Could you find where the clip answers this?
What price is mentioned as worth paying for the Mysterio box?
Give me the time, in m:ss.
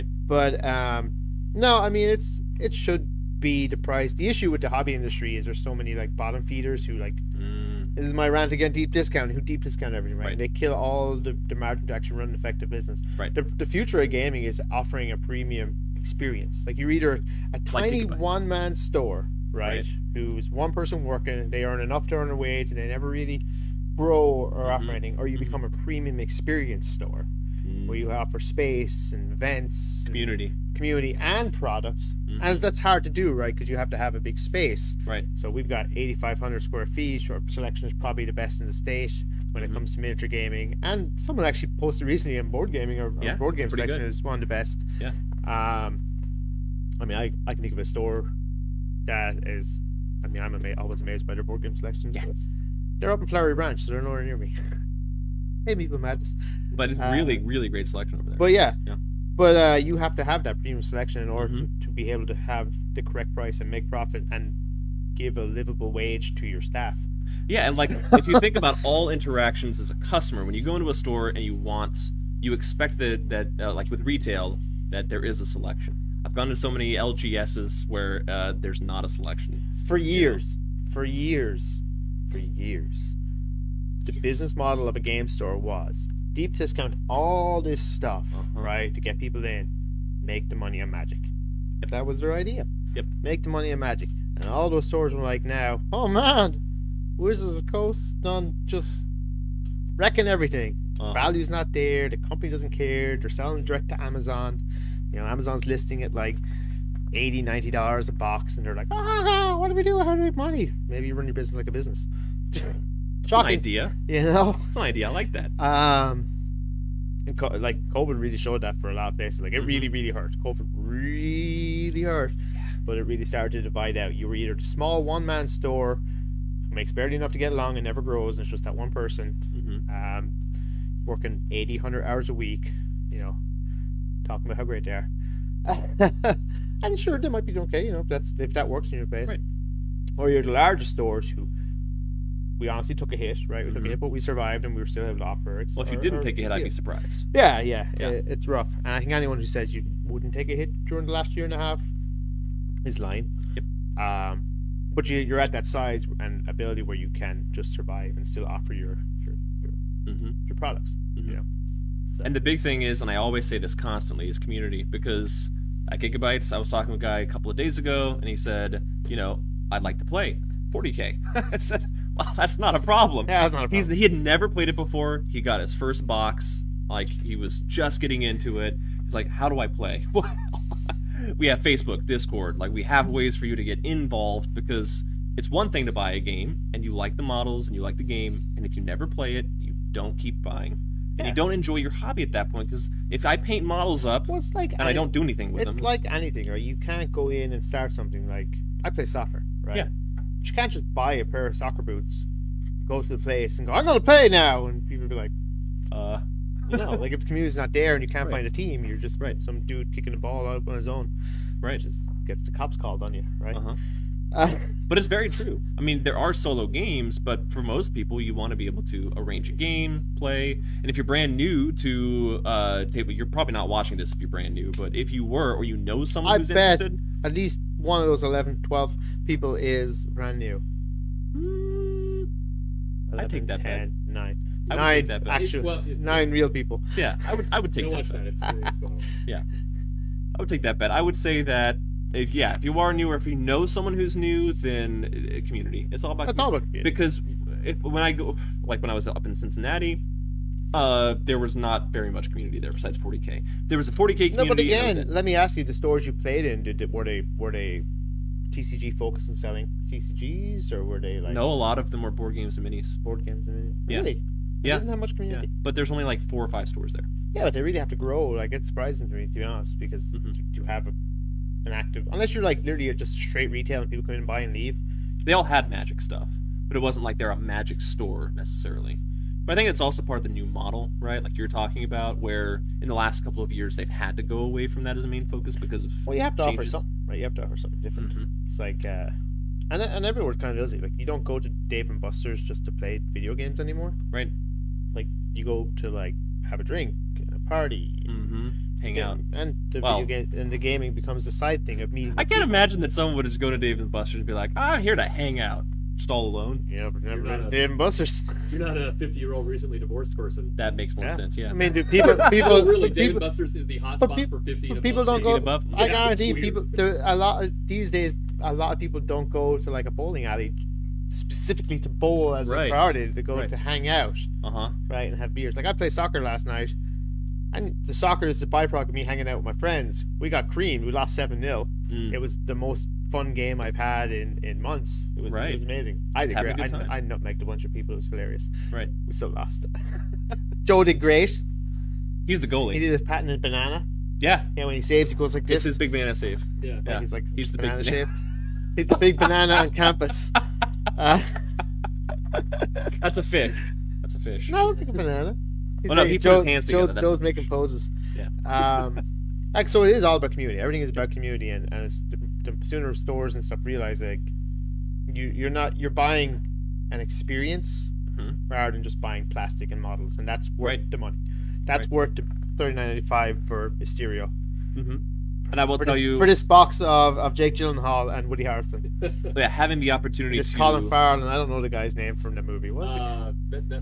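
6:12.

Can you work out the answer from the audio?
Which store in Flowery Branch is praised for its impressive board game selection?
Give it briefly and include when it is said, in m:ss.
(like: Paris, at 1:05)
Meeple Madness, at 0:55.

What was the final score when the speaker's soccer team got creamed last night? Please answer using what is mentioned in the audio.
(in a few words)
7-0.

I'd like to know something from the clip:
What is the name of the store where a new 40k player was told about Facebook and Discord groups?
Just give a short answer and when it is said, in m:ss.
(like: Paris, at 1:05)
Gigabytes, at 2:45.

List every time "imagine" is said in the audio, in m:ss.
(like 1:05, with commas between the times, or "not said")
5:02.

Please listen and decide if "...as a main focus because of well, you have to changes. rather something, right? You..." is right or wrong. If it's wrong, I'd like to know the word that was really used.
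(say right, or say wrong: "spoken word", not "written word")
wrong: "offer", not "rather".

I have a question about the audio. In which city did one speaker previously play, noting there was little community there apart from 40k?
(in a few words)
Cincinnati.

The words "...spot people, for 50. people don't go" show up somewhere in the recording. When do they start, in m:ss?
5:14.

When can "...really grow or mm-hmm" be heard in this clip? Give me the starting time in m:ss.
0:23.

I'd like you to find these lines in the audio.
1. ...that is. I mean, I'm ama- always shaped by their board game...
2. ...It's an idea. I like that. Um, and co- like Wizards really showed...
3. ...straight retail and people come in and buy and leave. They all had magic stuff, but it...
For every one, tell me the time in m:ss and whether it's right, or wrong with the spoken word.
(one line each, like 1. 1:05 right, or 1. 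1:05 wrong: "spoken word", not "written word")
1. 0:49 wrong: "amazed", not "shaped"
2. 1:54 wrong: "COVID", not "Wizards"
3. 4:33 right.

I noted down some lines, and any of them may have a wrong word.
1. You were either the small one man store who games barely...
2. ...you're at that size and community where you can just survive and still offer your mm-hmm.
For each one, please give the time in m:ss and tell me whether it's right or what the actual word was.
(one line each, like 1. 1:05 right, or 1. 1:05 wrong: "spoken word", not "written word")
1. 2:04 wrong: "makes", not "games"
2. 2:35 wrong: "ability", not "community".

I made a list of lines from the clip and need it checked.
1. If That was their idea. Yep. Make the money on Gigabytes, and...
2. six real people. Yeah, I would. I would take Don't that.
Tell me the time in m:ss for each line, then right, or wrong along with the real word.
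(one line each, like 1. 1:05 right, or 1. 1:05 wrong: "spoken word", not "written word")
1. 1:31 wrong: "Magic", not "Gigabytes"
2. 3:56 wrong: "nine", not "six".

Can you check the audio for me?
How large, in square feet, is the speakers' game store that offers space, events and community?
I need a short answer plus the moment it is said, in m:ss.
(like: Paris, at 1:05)
8,500 square feet, at 0:35.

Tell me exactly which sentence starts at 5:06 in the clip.
Yeah, but never Dave and Buster's.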